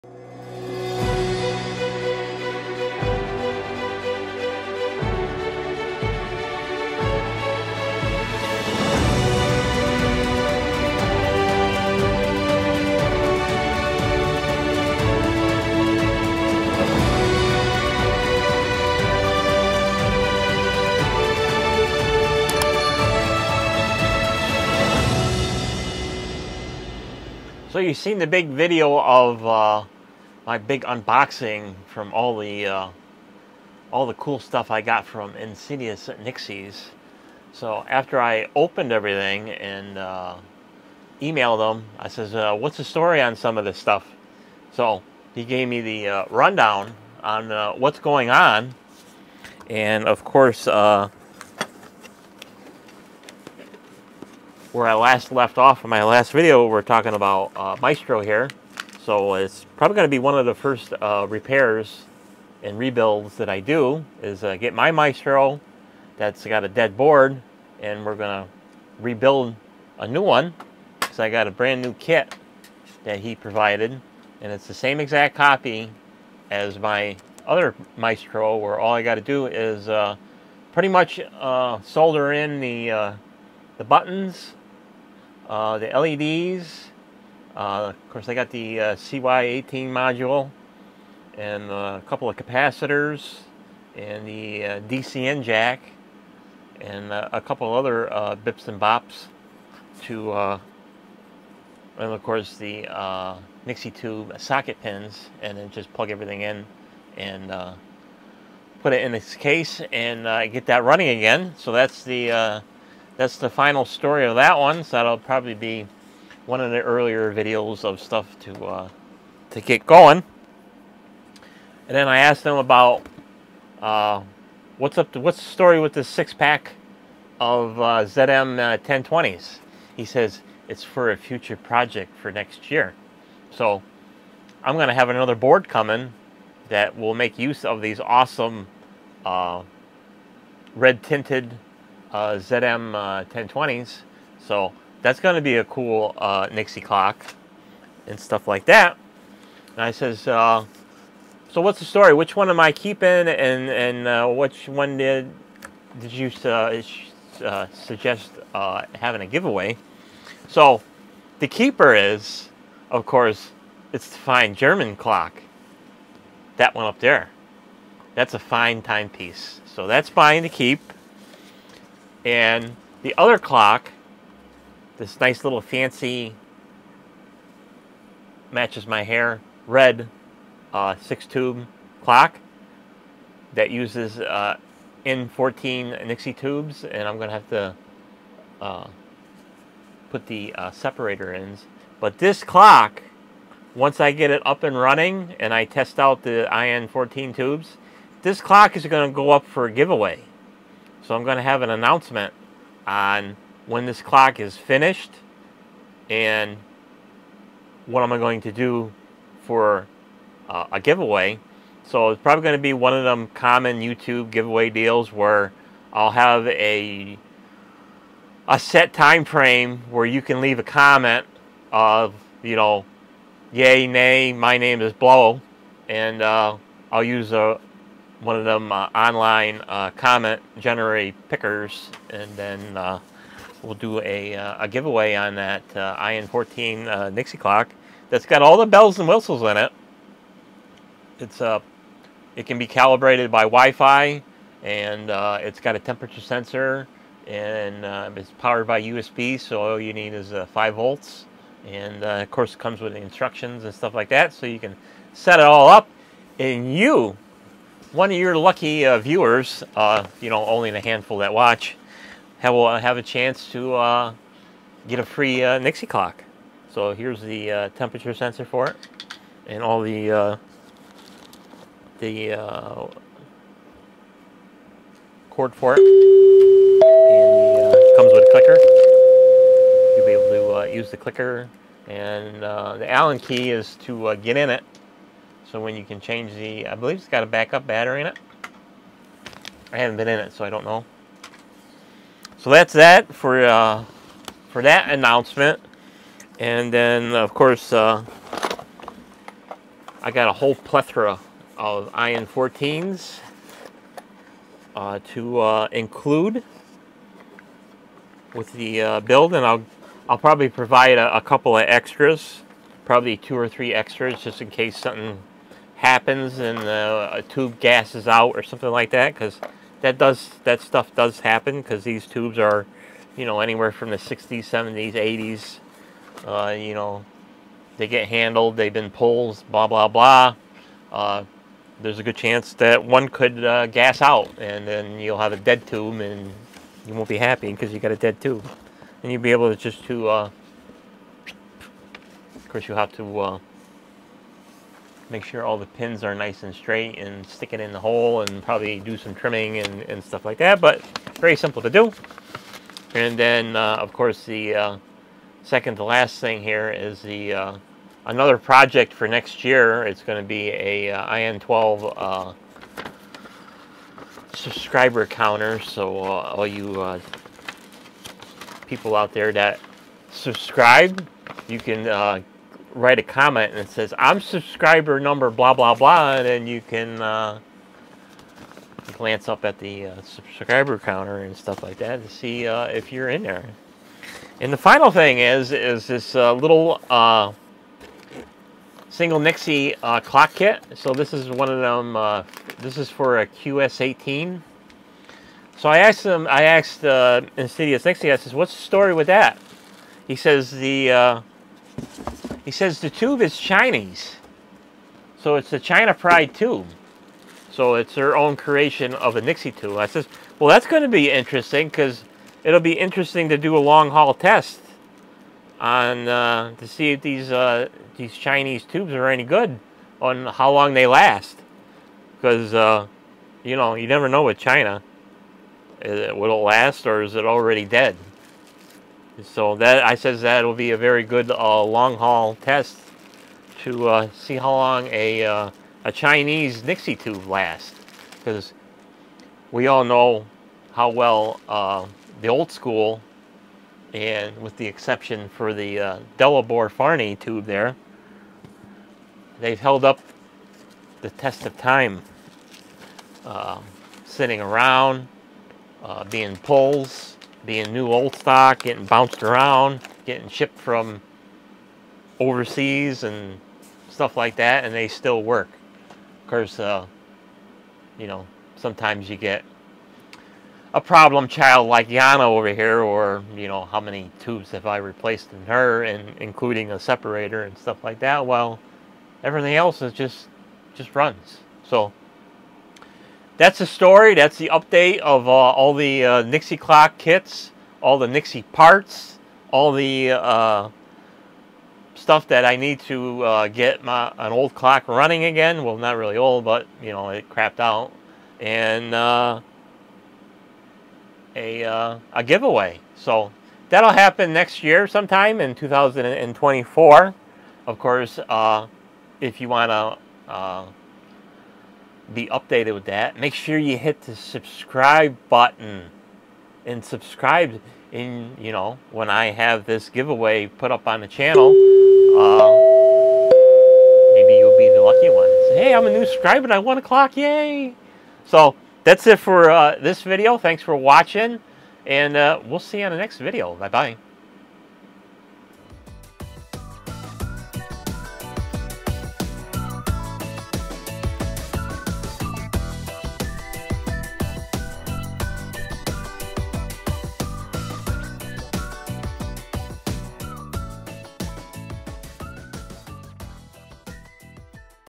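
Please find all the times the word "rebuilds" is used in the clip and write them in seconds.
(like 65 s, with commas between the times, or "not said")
62 s, 69 s.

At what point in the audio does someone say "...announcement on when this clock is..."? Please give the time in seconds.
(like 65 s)
201 s.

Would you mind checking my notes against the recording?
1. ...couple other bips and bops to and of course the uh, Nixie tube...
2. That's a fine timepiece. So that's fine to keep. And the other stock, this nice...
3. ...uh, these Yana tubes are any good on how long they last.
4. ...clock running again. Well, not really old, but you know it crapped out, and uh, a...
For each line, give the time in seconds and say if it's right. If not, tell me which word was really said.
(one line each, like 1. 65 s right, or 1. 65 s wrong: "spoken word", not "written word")
1. 97 s right
2. 168 s wrong: "clock", not "stock"
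3. 417 s wrong: "Chinese", not "Yana"
4. 494 s right.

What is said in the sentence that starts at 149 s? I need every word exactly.
And I says, uh, so what's the story?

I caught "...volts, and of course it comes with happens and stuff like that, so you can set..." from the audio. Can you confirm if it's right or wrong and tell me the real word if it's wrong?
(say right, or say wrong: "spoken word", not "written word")
wrong: "instructions", not "happens".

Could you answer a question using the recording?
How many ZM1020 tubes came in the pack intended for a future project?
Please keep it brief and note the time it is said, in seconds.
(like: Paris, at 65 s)
6, at 126 s.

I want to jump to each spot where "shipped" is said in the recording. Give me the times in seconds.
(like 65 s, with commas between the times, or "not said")
460 s.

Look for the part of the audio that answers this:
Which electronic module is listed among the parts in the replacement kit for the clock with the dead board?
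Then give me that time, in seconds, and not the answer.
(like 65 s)
88 s.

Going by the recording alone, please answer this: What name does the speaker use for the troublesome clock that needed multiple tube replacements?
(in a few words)
Yana.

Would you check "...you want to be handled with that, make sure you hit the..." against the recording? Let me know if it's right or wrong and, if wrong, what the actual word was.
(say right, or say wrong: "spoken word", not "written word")
wrong: "updated", not "handled".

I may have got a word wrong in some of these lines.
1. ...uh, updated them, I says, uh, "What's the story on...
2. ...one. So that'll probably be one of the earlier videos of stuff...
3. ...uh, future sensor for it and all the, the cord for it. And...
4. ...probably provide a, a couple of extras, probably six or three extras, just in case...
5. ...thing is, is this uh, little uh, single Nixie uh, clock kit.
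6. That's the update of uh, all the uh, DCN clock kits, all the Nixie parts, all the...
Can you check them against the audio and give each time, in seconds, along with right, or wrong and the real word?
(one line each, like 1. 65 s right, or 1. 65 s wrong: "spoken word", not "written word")
1. 39 s wrong: "emailed", not "updated"
2. 114 s right
3. 267 s wrong: "temperature", not "future"
4. 310 s wrong: "two", not "six"
5. 384 s right
6. 484 s wrong: "Nixie", not "DCN".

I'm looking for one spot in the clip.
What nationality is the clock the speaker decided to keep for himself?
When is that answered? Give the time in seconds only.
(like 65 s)
164 s.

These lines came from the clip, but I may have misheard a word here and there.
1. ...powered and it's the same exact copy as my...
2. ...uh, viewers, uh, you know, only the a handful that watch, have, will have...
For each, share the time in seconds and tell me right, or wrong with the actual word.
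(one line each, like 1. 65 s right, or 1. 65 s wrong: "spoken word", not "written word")
1. 73 s wrong: "provided", not "powered"
2. 258 s right.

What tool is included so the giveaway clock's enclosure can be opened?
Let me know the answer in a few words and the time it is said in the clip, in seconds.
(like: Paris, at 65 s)
Allen key, at 282 s.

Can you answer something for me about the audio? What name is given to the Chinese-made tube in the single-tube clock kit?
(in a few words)
China Pride.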